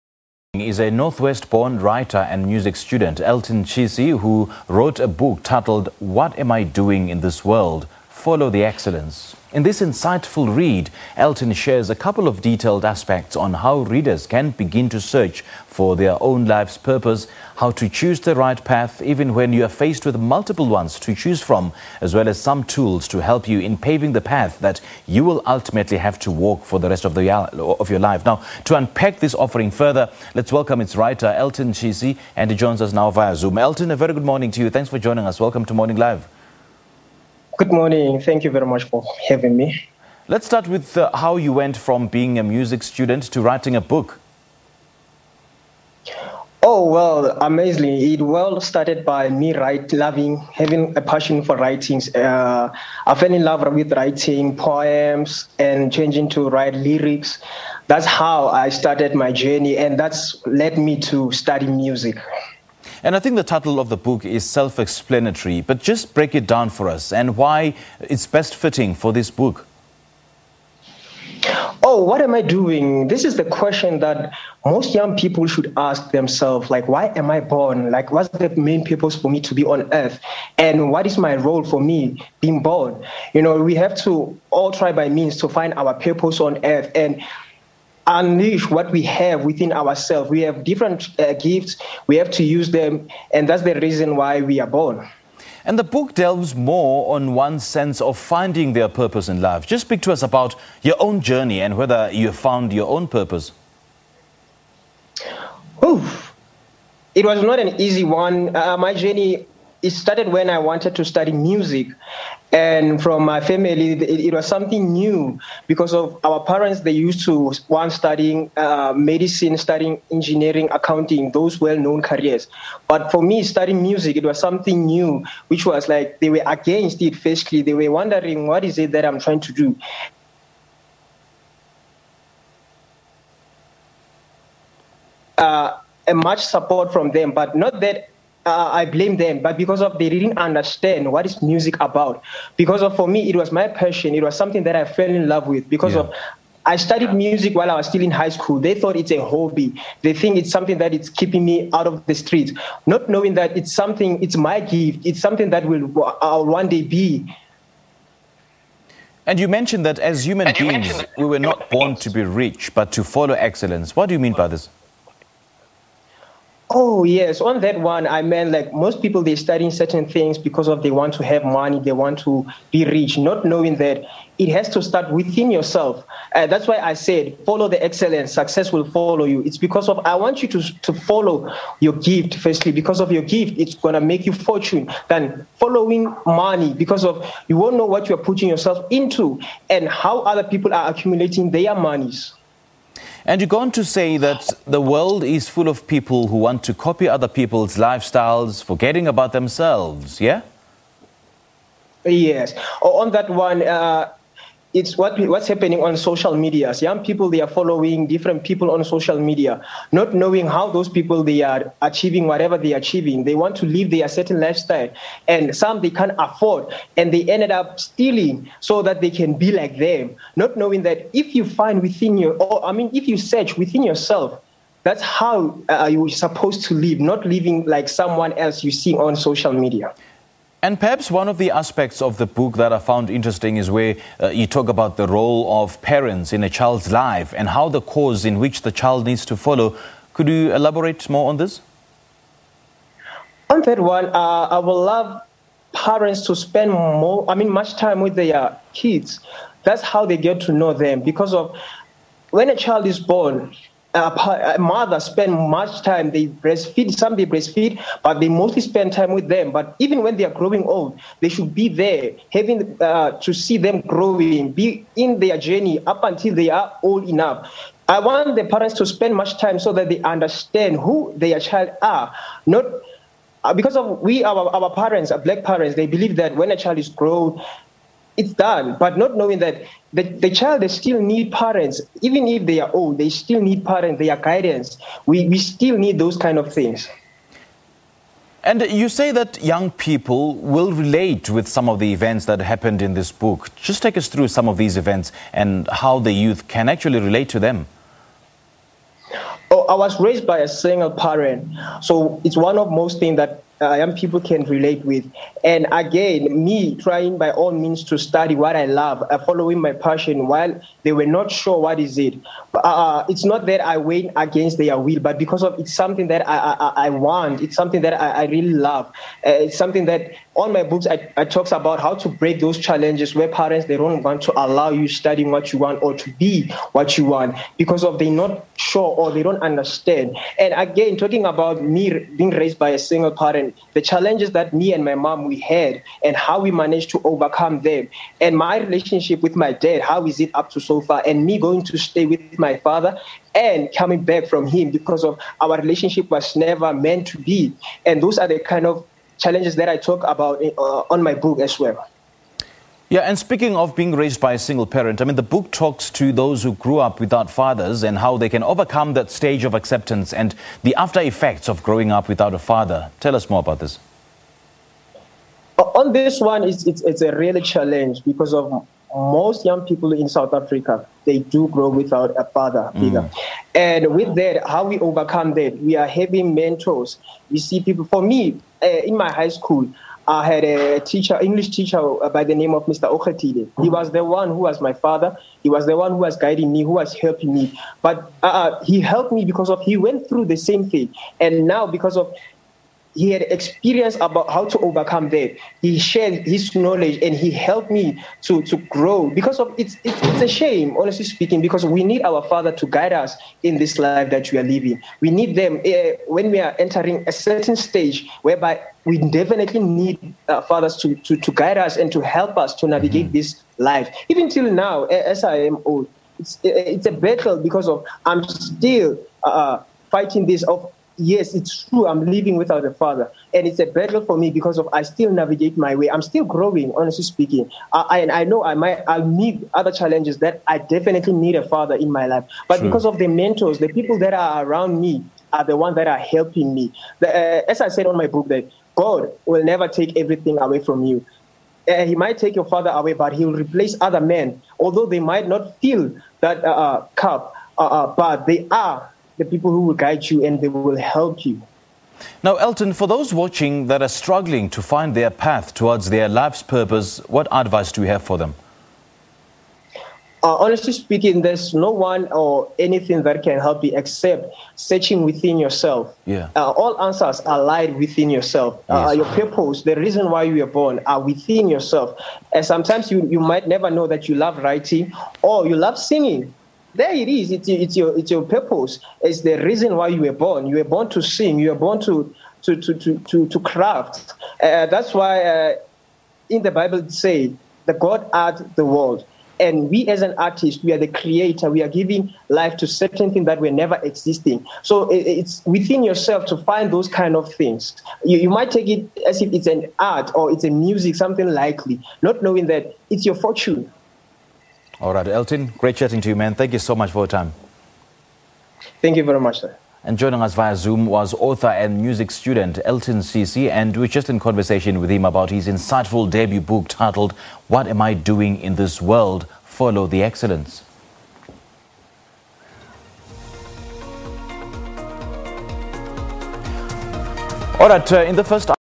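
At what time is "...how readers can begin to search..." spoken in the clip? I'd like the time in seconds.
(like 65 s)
13 s.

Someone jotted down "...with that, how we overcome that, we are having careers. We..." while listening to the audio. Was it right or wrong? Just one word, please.
wrong.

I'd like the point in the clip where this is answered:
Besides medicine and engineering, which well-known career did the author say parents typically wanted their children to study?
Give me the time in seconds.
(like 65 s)
120 s.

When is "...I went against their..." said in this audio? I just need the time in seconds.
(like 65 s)
313 s.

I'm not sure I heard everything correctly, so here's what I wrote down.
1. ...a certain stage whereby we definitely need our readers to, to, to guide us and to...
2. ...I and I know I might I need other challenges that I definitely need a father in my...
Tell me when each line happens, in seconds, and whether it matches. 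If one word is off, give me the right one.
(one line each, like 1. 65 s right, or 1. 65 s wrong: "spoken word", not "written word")
1. 407 s wrong: "fathers", not "readers"
2. 427 s right.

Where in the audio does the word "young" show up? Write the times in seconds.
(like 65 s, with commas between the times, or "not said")
74 s, 206 s, 289 s, 303 s, 369 s.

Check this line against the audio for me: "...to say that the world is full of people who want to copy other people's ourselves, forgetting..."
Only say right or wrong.
wrong.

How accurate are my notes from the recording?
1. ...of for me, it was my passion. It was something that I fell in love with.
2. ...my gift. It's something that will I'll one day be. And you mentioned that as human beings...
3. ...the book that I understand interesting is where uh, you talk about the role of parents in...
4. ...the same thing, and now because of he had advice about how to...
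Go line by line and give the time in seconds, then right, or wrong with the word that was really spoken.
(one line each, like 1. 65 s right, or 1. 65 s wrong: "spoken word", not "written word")
1. 142 s right
2. 154 s right
3. 232 s wrong: "found", not "understand"
4. 390 s wrong: "experience", not "advice".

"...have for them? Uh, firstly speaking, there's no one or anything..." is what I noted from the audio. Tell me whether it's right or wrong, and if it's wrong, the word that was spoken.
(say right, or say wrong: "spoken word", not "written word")
wrong: "honestly", not "firstly".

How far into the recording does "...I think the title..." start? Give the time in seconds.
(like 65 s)
63 s.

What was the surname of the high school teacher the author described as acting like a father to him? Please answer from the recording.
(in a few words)
Okhatile.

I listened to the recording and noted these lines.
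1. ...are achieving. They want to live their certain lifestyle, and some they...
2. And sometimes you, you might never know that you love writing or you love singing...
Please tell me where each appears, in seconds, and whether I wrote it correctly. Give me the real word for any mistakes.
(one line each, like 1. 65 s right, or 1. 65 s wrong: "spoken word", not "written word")
1. 212 s right
2. 472 s right.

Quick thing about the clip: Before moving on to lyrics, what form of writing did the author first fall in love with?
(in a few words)
Poems.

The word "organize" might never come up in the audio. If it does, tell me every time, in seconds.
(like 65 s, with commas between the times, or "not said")
not said.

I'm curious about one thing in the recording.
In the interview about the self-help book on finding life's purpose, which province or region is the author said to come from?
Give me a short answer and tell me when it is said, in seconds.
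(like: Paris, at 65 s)
Northwest, at 0 s.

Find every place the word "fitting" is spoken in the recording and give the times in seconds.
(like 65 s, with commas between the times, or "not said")
68 s.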